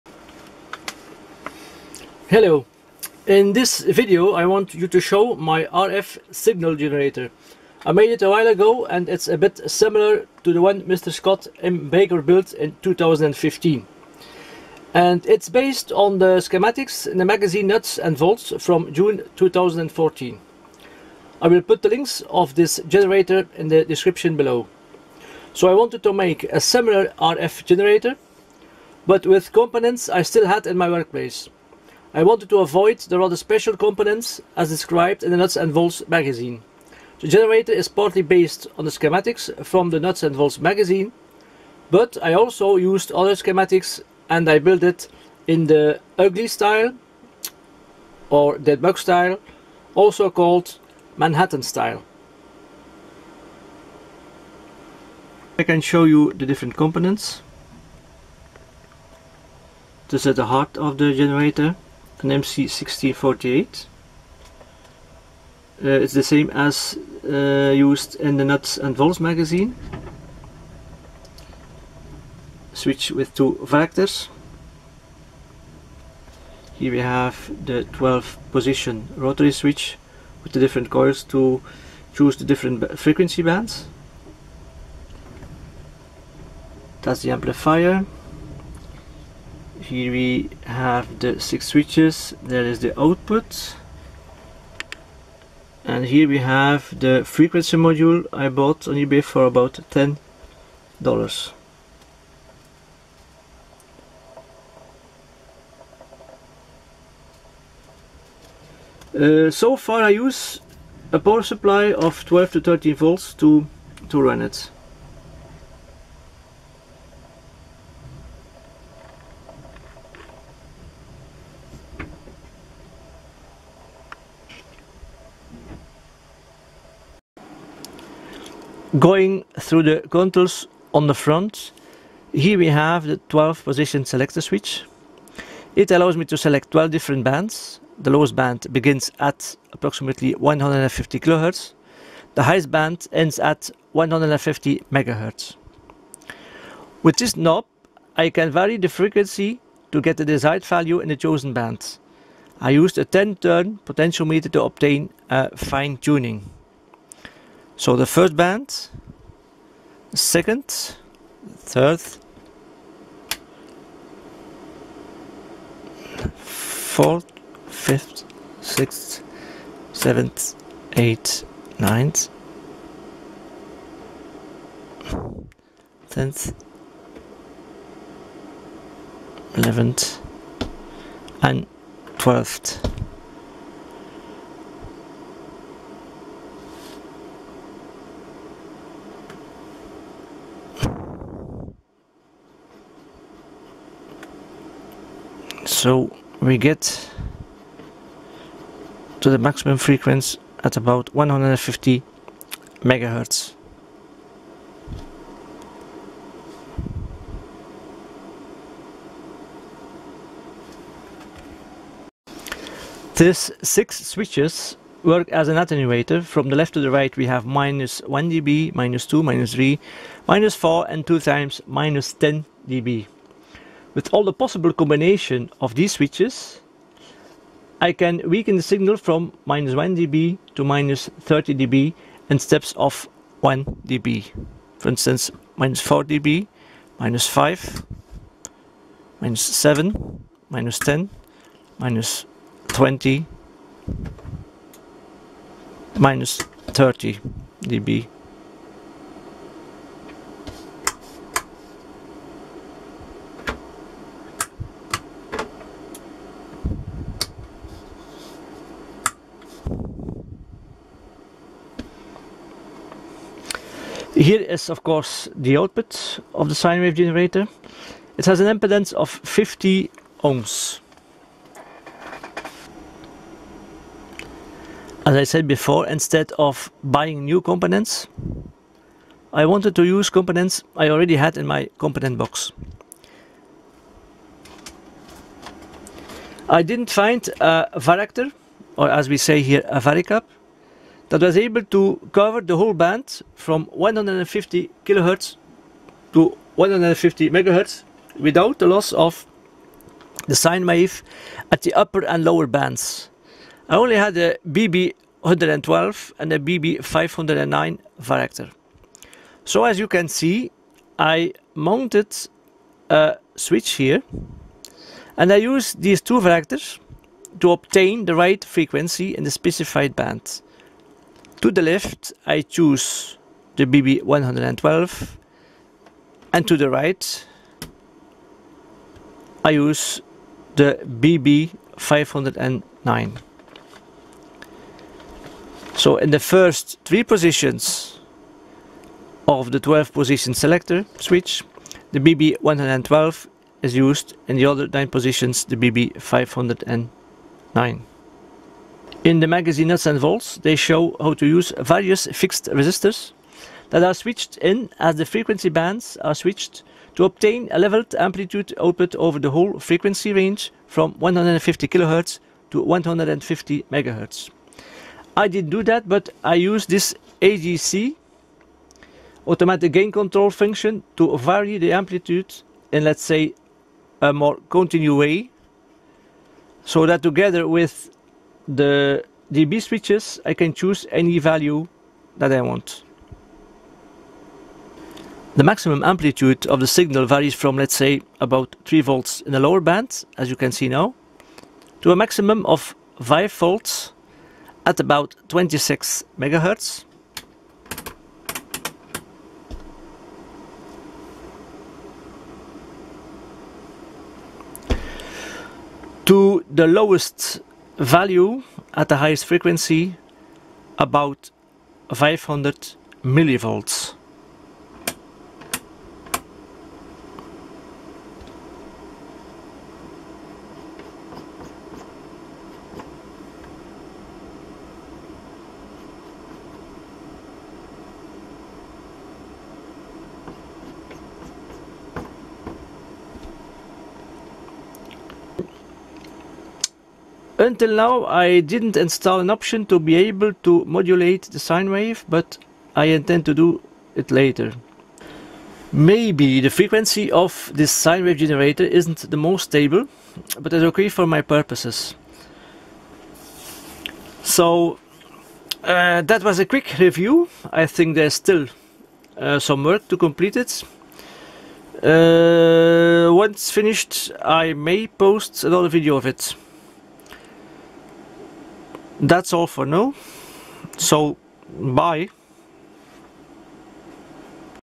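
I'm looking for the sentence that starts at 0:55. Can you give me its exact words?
I can show you the different components.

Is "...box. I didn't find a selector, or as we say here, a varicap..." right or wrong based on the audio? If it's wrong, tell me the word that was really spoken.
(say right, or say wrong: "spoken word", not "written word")
wrong: "varactor", not "selector".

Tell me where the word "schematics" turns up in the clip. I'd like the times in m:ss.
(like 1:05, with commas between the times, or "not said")
0:16, 0:38, 0:43.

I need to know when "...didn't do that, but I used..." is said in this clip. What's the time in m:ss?
6:05.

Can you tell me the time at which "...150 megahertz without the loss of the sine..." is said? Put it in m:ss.
4:56.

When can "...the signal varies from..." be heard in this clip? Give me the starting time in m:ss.
6:26.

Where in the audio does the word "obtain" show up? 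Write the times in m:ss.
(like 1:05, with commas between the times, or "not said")
2:34, 5:17, 5:57.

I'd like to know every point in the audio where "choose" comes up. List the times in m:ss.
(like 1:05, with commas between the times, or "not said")
1:22, 5:22, 6:20.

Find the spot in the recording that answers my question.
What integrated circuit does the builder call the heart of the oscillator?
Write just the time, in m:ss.
1:02.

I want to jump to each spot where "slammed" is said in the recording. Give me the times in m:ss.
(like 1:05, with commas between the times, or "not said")
not said.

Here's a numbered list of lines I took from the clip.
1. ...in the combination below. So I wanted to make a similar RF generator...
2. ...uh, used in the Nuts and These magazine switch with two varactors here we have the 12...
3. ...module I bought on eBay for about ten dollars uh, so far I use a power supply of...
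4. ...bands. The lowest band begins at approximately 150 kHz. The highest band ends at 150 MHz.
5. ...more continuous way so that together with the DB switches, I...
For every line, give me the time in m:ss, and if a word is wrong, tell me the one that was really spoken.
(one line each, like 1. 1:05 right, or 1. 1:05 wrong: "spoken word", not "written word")
1. 0:23 wrong: "description", not "combination"
2. 1:07 wrong: "Volts", not "These"
3. 1:37 right
4. 2:17 right
5. 6:14 right.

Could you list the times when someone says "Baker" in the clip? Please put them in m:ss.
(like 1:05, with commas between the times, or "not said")
0:11.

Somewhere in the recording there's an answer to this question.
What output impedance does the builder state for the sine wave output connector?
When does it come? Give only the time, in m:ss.
4:29.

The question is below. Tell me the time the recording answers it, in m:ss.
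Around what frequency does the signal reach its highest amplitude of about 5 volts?
6:35.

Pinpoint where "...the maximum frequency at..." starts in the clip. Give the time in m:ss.
3:19.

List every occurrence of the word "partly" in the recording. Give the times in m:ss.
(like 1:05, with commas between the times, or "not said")
0:37.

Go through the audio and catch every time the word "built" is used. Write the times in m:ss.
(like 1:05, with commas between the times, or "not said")
0:12, 0:44.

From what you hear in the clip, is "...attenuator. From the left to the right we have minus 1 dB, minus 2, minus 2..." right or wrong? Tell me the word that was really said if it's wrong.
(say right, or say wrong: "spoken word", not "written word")
wrong: "3", not "2".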